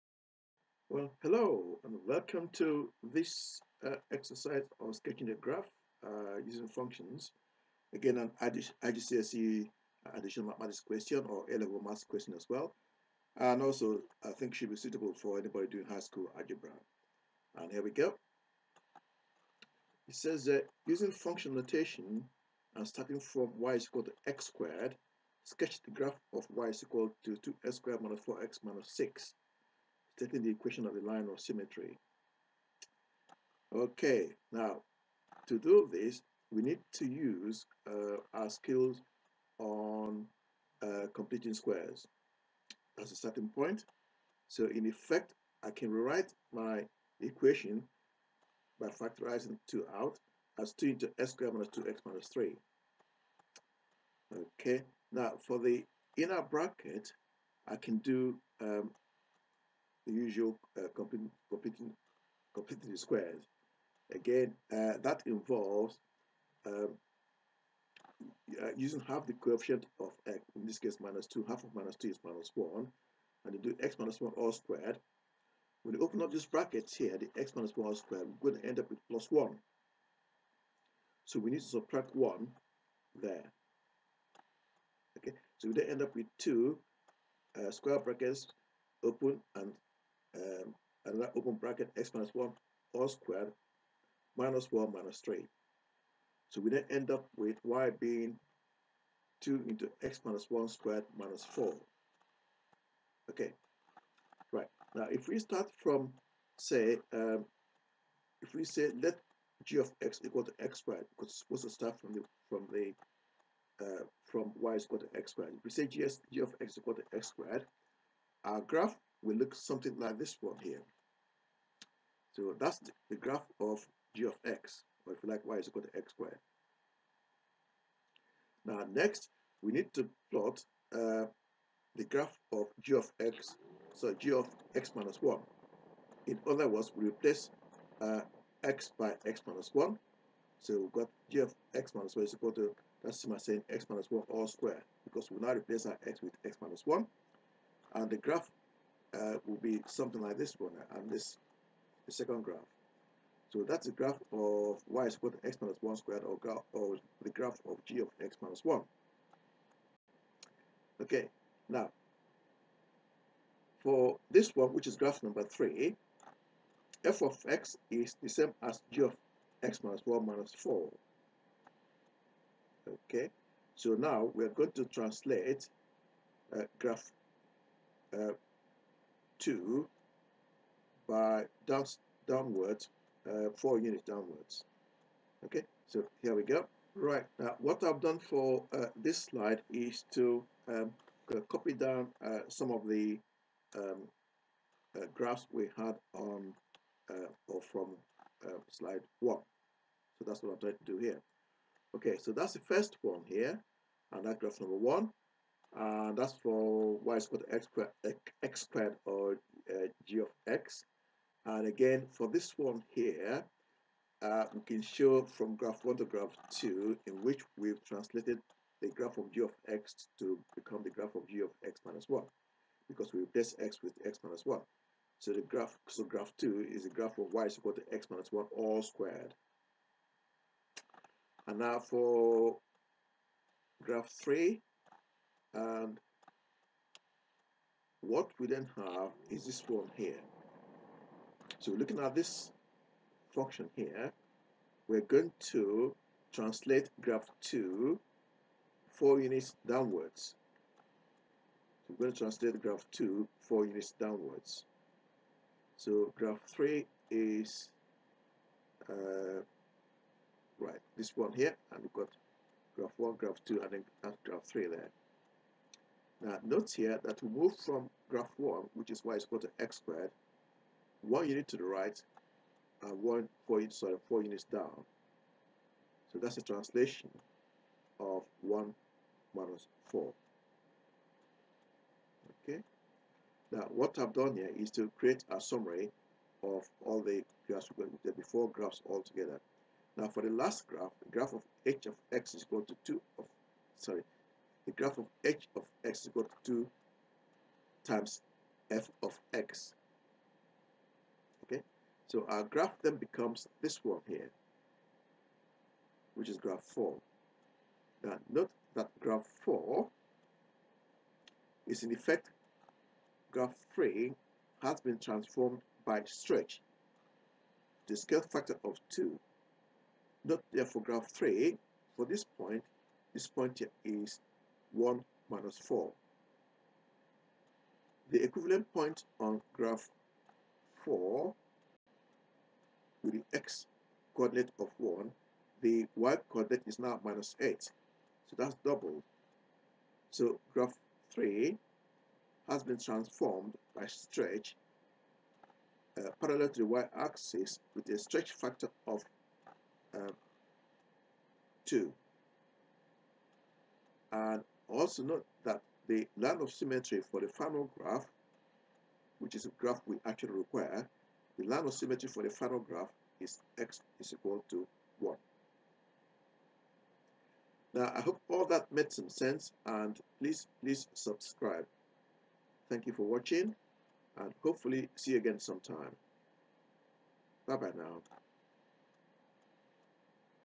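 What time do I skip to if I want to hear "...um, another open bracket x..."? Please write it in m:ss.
1:30.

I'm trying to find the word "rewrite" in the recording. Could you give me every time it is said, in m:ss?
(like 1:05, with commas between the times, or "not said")
0:45.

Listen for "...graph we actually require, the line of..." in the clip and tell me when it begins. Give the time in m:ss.
5:59.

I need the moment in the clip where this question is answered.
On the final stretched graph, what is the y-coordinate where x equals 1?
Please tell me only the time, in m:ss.
5:37.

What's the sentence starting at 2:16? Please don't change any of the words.
In other words, we replace uh, x by x minus 1.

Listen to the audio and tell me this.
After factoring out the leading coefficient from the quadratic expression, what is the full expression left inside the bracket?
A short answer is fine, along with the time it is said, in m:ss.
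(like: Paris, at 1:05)
x² - 2x - 3, at 0:51.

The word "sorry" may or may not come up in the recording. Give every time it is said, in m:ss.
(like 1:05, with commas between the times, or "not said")
4:33, 4:53.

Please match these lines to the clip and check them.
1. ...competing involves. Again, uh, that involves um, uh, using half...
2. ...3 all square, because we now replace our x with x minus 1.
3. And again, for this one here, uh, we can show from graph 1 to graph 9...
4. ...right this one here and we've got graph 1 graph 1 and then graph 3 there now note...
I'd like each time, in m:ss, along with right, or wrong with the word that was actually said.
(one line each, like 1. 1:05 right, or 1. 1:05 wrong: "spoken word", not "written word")
1. 1:02 wrong: "squares", not "involves"
2. 2:24 wrong: "1", not "3"
3. 3:31 wrong: "2", not "9"
4. 4:20 wrong: "2", not "1".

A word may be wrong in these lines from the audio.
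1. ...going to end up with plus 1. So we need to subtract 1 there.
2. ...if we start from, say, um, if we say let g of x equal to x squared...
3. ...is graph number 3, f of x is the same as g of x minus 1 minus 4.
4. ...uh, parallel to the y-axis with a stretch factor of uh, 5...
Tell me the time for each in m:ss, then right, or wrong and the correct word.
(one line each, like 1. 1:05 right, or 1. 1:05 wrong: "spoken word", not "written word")
1. 1:18 right
2. 1:45 right
3. 2:44 right
4. 5:45 wrong: "2", not "5".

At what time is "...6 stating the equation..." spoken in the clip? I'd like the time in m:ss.
0:28.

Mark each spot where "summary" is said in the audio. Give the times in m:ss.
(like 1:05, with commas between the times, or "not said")
4:45.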